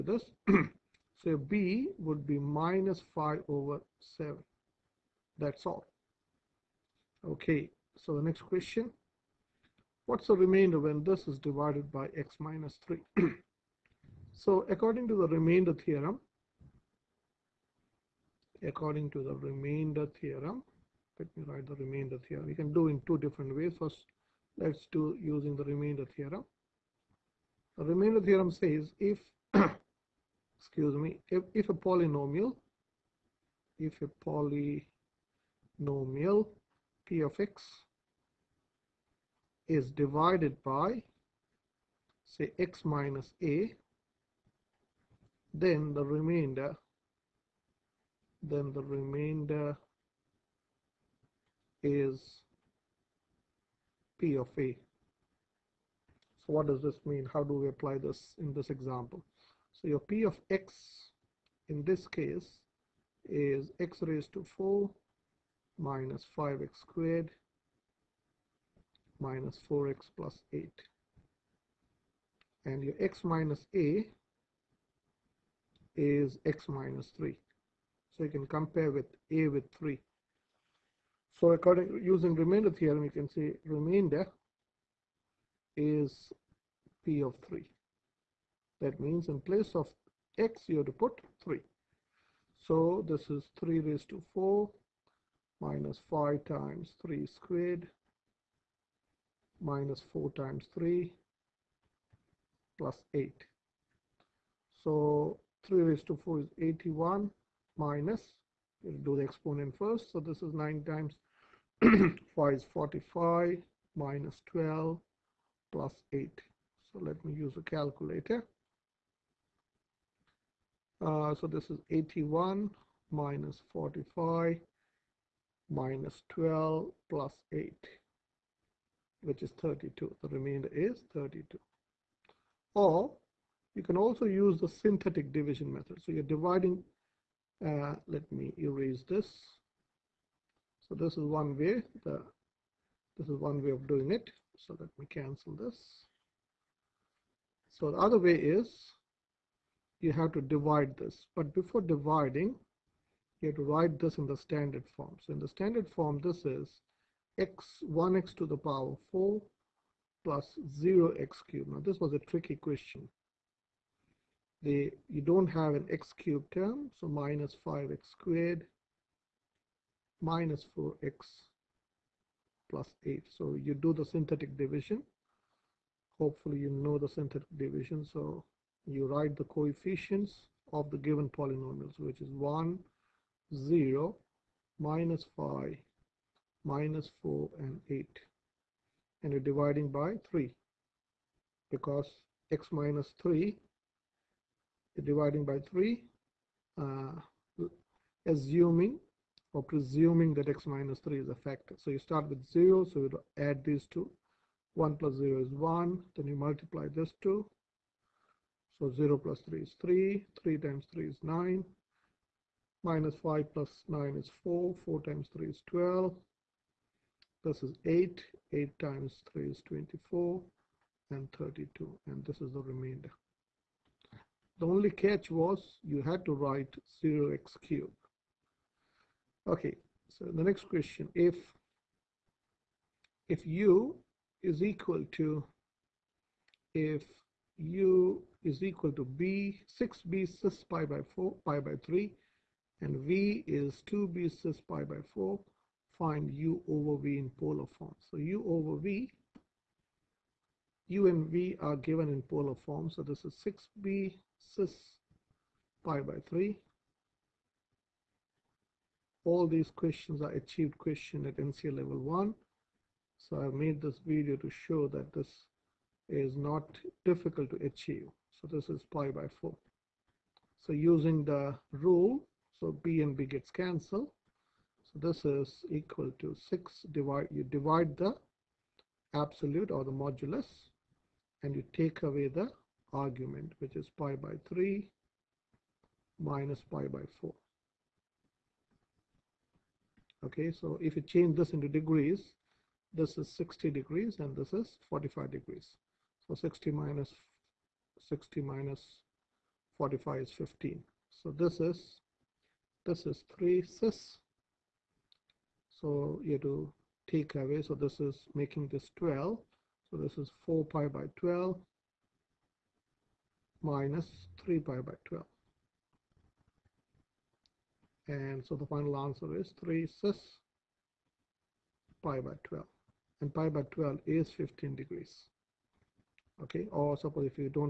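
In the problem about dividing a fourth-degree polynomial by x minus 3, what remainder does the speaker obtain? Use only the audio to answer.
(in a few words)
32.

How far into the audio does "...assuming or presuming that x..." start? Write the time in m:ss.
3:18.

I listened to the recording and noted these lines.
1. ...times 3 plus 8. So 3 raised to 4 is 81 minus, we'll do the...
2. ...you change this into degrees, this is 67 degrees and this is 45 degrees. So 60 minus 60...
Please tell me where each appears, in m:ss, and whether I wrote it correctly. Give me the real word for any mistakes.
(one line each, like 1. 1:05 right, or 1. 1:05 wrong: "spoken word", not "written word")
1. 1:40 right
2. 4:50 wrong: "60", not "67".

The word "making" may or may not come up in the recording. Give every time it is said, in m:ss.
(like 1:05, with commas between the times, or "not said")
5:08.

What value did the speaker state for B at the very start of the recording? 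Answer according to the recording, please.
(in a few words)
-5/7.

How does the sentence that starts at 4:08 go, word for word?
So U over V, U and V are given in polar form.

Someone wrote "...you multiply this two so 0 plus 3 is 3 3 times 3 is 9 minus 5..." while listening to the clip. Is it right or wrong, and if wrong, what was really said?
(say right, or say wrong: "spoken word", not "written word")
right.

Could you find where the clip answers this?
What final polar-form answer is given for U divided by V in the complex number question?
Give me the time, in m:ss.
5:19.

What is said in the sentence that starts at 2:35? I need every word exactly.
So in the standard form, this is x 1x to the power 4 plus 0x cubed.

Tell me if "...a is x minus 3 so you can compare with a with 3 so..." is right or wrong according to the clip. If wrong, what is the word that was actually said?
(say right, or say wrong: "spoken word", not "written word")
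right.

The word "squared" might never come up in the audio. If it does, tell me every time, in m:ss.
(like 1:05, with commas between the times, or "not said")
1:06, 1:37, 2:48.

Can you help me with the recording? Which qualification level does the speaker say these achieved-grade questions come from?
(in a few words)
NCEA level 1.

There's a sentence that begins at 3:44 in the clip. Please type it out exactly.
The only catch was you had to write 0x cubed.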